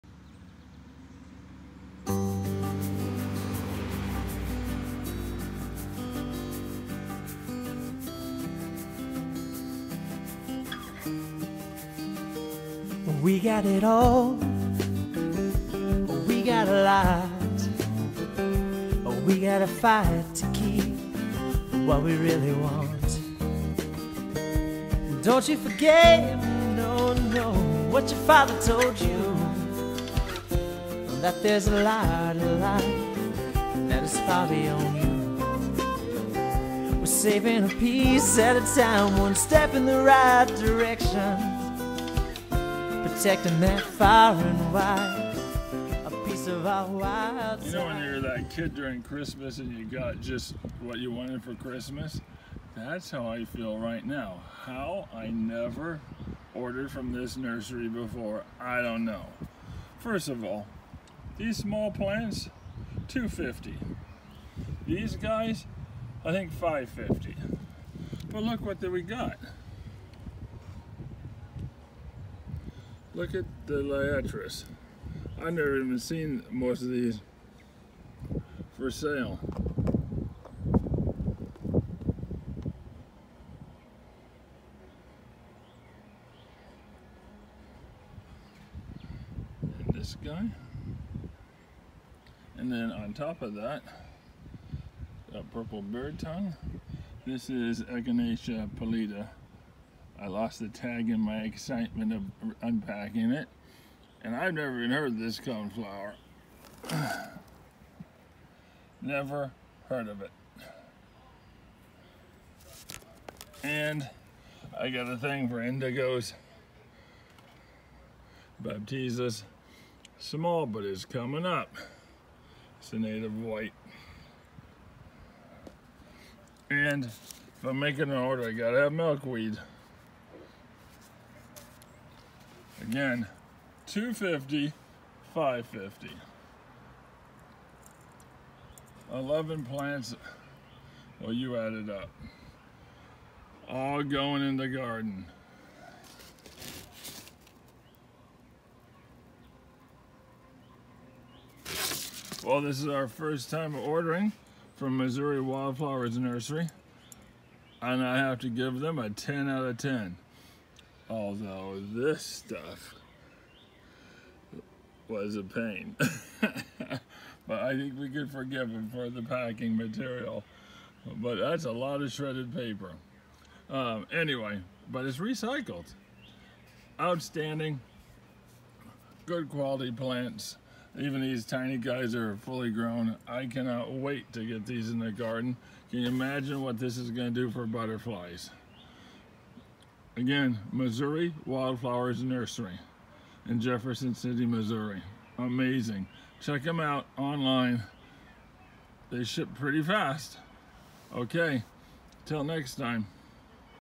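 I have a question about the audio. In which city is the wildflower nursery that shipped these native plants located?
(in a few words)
Jefferson City, Missouri.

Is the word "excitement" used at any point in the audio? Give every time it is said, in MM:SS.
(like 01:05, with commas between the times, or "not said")
01:41.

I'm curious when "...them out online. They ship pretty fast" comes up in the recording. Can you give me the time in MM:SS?
03:16.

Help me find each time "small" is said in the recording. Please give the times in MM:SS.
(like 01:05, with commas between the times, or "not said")
01:01, 02:00.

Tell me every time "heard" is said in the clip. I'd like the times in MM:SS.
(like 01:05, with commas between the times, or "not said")
01:44, 01:49.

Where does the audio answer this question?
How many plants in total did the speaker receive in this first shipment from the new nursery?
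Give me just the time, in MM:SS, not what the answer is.
02:19.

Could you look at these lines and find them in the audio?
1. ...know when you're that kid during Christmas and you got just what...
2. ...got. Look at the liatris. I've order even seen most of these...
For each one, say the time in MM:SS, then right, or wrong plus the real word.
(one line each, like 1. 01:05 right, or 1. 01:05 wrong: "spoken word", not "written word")
1. 00:47 right
2. 01:09 wrong: "never", not "order".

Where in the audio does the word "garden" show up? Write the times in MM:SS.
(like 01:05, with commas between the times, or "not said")
02:24, 03:05.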